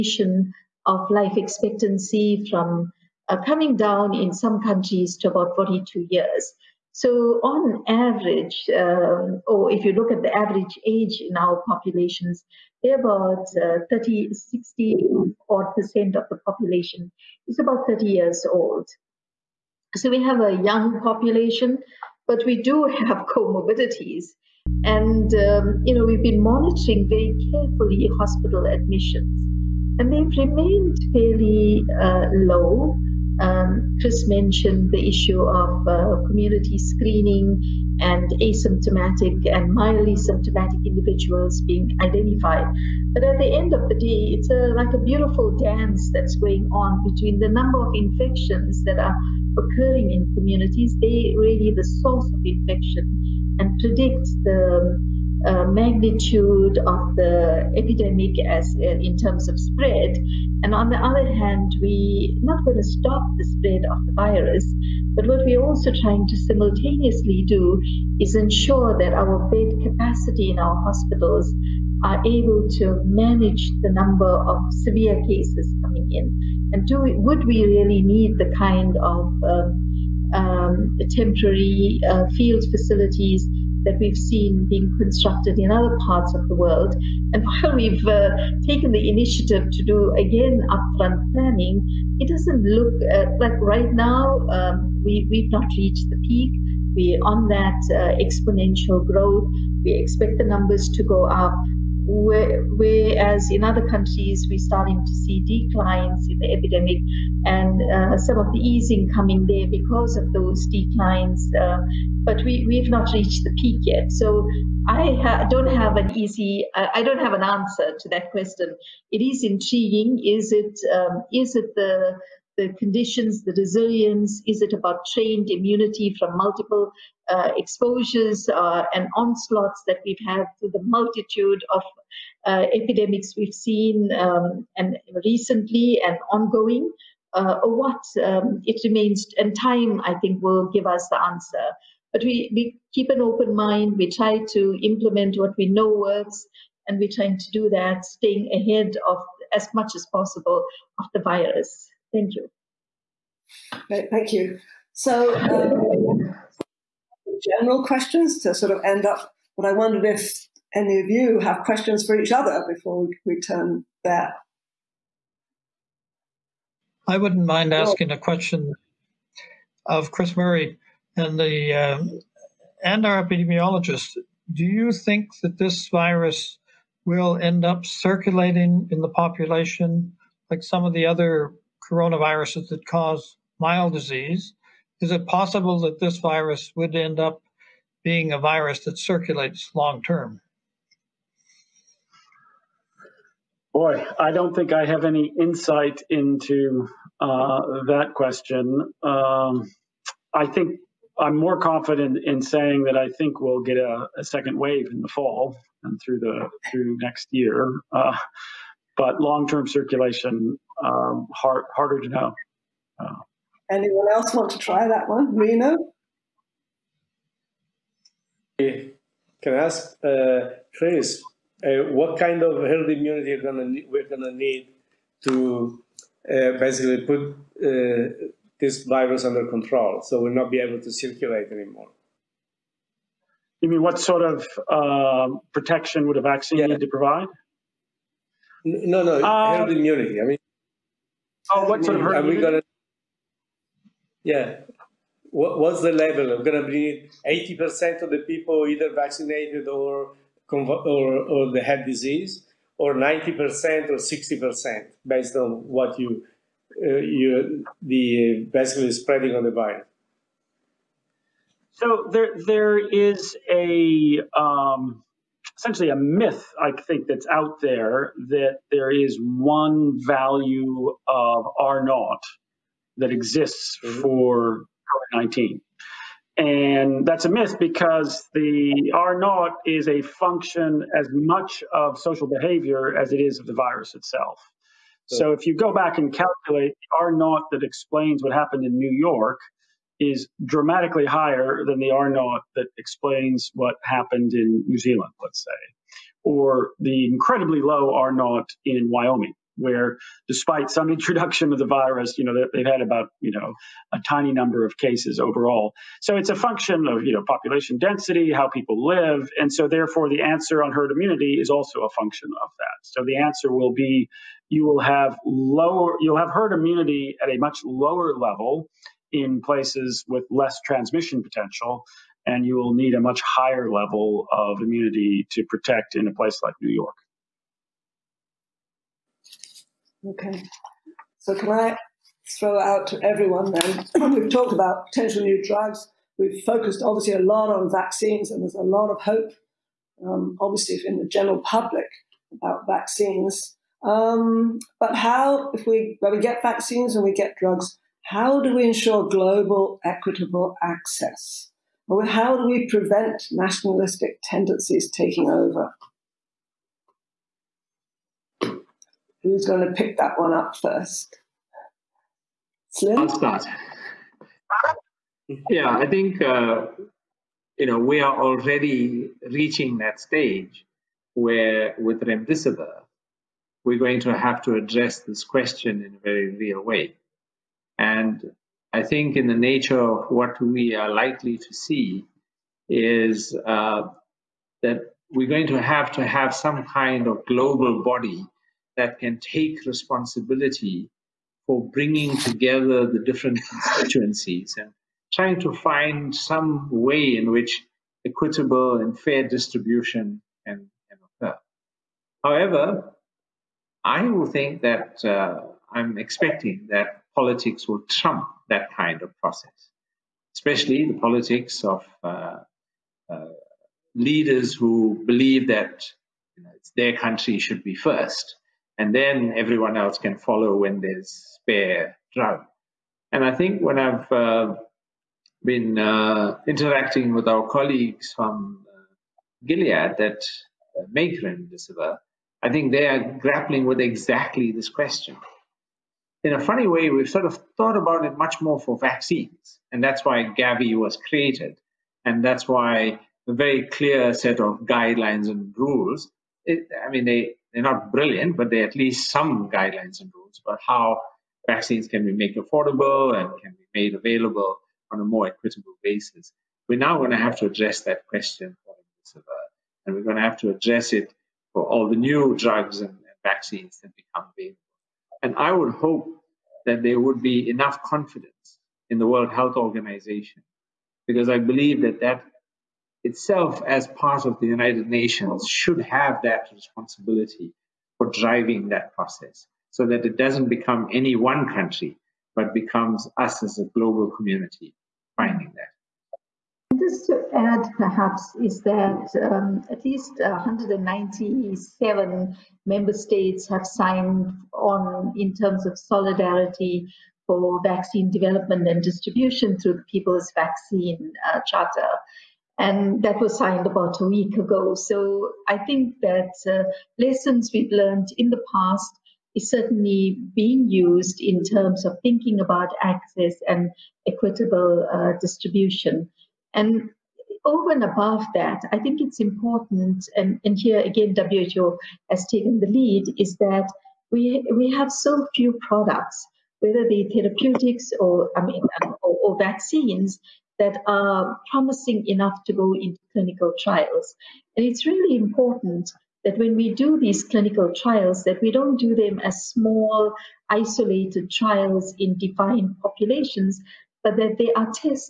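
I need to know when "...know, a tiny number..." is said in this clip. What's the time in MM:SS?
05:03.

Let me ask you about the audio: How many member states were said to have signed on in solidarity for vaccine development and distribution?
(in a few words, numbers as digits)
197.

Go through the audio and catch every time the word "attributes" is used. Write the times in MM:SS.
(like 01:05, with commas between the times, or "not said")
not said.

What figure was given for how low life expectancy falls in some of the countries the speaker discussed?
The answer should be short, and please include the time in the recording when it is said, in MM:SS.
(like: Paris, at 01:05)
42 years, at 00:05.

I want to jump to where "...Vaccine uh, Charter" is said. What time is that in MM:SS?
08:20.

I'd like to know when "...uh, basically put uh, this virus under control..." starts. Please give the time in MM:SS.
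03:46.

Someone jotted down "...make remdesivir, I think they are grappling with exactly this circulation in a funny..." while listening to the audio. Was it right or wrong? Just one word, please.
wrong.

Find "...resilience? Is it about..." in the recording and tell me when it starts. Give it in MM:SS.
02:03.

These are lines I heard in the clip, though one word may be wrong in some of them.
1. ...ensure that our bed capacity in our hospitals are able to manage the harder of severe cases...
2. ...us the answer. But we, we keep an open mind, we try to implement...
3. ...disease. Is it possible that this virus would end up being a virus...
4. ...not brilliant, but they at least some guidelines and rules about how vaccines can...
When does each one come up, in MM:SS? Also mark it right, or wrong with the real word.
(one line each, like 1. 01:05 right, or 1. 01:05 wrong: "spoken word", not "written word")
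1. 01:08 wrong: "number", not "harder"
2. 02:20 right
3. 03:03 right
4. 07:27 right.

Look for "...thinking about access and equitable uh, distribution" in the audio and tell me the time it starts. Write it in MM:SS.
08:32.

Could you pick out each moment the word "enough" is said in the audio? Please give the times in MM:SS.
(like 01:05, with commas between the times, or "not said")
07:47, 08:52.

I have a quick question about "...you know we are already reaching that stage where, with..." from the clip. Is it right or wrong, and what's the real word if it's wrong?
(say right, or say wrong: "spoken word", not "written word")
right.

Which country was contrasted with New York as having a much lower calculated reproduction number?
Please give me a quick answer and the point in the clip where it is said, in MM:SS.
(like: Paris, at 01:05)
New Zealand, at 04:54.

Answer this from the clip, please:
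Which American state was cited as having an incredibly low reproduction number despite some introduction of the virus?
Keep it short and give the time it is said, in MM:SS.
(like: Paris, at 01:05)
Wyoming, at 04:58.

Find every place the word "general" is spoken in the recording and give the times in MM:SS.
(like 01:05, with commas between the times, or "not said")
02:37, 05:41.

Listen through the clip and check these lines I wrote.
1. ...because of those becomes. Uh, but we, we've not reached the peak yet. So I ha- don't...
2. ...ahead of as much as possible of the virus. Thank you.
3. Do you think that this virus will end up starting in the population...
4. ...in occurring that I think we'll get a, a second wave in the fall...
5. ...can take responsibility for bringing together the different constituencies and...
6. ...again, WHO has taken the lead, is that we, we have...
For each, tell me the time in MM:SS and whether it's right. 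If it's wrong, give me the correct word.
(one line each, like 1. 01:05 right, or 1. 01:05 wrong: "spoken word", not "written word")
1. 01:49 wrong: "declines", not "becomes"
2. 02:28 right
3. 02:54 wrong: "circulating", not "starting"
4. 03:22 wrong: "saying", not "occurring"
5. 06:28 right
6. 08:40 right.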